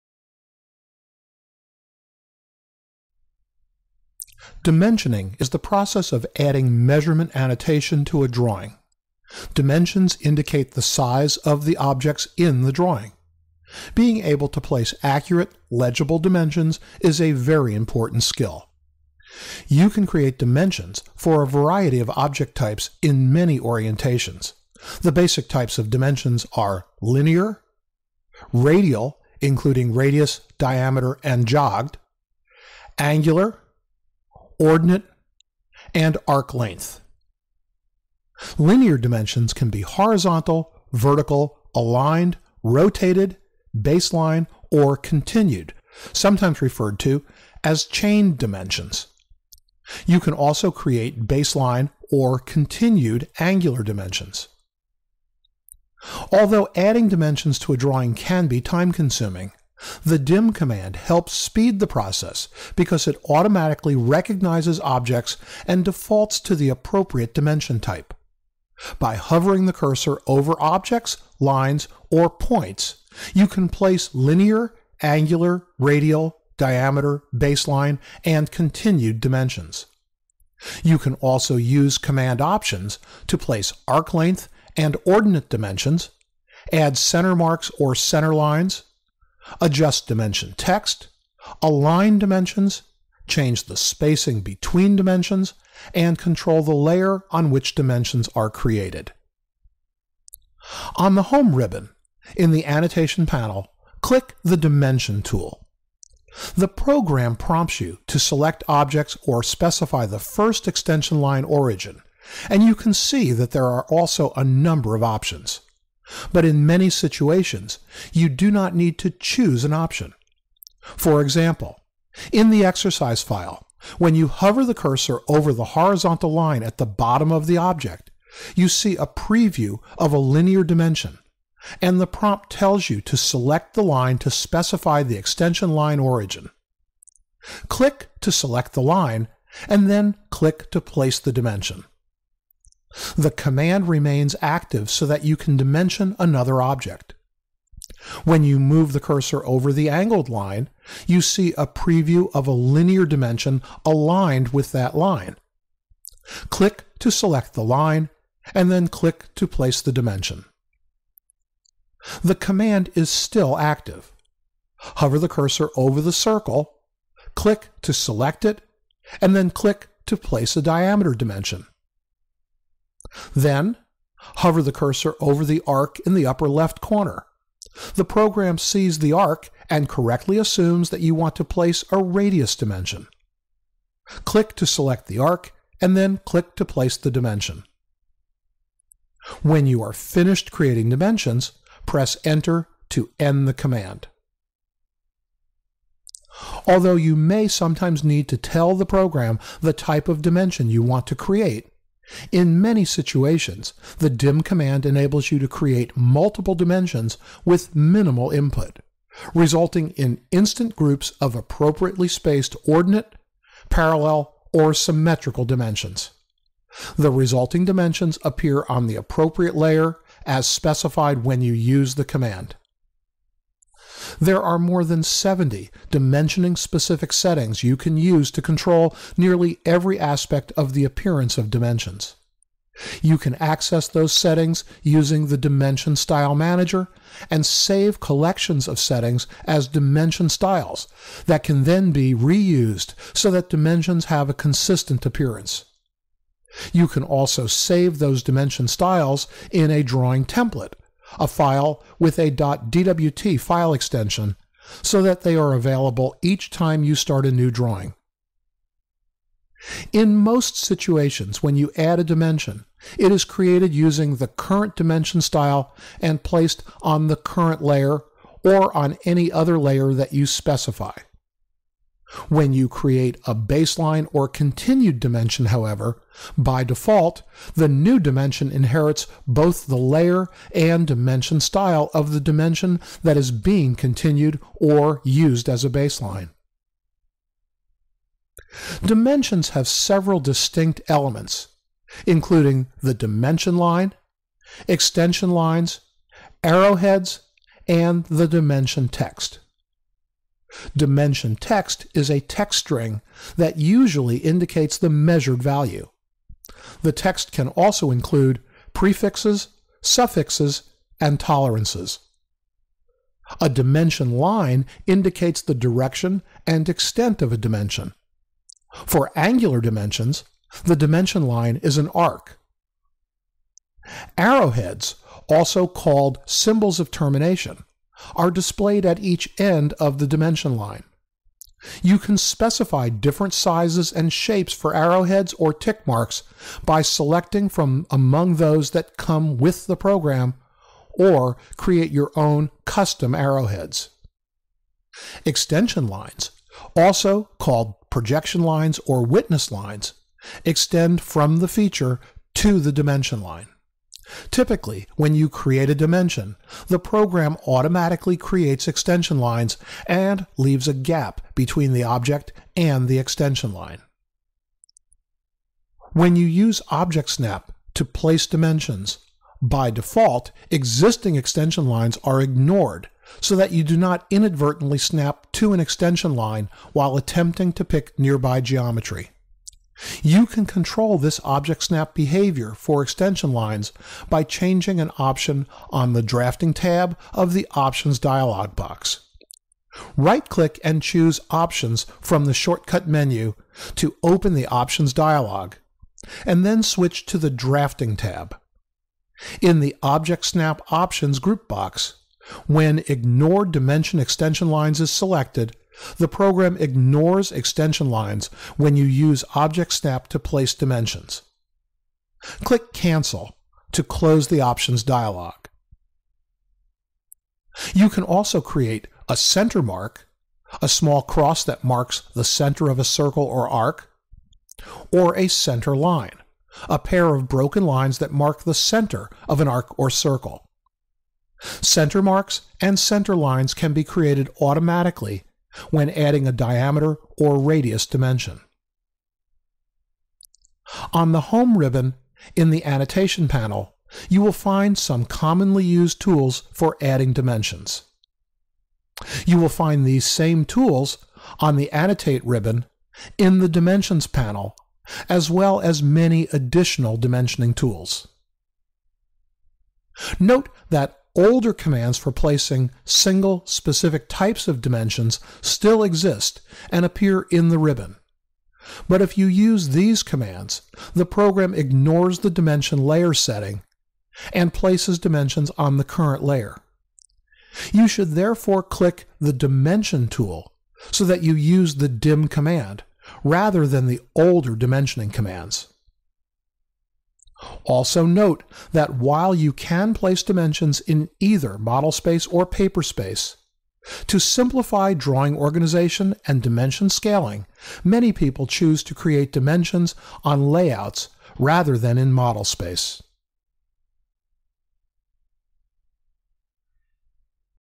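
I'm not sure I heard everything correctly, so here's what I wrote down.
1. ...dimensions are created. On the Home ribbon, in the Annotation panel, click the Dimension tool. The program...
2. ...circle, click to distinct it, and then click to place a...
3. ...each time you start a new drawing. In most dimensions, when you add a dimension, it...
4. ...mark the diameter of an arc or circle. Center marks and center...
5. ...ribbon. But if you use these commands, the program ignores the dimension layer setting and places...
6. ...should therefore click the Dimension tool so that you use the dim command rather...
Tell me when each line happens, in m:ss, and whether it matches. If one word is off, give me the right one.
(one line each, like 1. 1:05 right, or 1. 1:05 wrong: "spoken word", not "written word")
1. 1:37 right
2. 2:46 wrong: "select", not "distinct"
3. 4:16 wrong: "situations", not "dimensions"
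4. 7:08 wrong: "center", not "diameter"
5. 7:47 right
6. 7:57 right.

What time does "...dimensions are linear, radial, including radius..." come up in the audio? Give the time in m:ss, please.
0:25.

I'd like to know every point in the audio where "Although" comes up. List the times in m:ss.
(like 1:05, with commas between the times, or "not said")
0:56, 3:16.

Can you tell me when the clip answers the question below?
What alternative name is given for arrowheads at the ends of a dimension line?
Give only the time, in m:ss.
5:26.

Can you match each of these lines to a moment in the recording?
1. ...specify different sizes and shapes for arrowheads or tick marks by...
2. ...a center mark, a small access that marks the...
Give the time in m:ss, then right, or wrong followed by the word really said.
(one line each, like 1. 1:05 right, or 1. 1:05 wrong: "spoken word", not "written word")
1. 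5:32 right
2. 6:59 wrong: "cross", not "access".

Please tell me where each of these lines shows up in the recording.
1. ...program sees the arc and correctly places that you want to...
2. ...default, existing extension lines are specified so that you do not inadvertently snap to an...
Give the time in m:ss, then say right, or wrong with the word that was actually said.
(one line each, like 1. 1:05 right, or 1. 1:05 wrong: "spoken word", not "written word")
1. 2:58 wrong: "assumes", not "places"
2. 6:09 wrong: "ignored", not "specified".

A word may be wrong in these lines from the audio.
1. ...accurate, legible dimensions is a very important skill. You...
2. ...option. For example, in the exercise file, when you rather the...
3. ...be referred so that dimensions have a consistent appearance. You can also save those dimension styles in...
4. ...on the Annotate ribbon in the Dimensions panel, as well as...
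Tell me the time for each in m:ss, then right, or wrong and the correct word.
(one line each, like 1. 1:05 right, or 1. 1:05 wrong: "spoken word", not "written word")
1. 0:15 right
2. 1:59 wrong: "hover", not "rather"
3. 4:01 wrong: "reused", not "referred"
4. 7:31 right.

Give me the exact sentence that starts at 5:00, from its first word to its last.
Dimension text is a text string that usually indicates the measured value.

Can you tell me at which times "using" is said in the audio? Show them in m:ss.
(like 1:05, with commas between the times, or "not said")
3:54, 4:23.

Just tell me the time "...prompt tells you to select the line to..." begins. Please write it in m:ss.
2:12.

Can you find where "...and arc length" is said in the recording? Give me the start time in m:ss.
0:35.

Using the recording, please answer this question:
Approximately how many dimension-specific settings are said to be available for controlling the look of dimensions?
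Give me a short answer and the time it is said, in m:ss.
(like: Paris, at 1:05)
more than 70, at 3:44.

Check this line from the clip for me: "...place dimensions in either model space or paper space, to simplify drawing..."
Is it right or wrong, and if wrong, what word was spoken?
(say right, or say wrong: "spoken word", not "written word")
right.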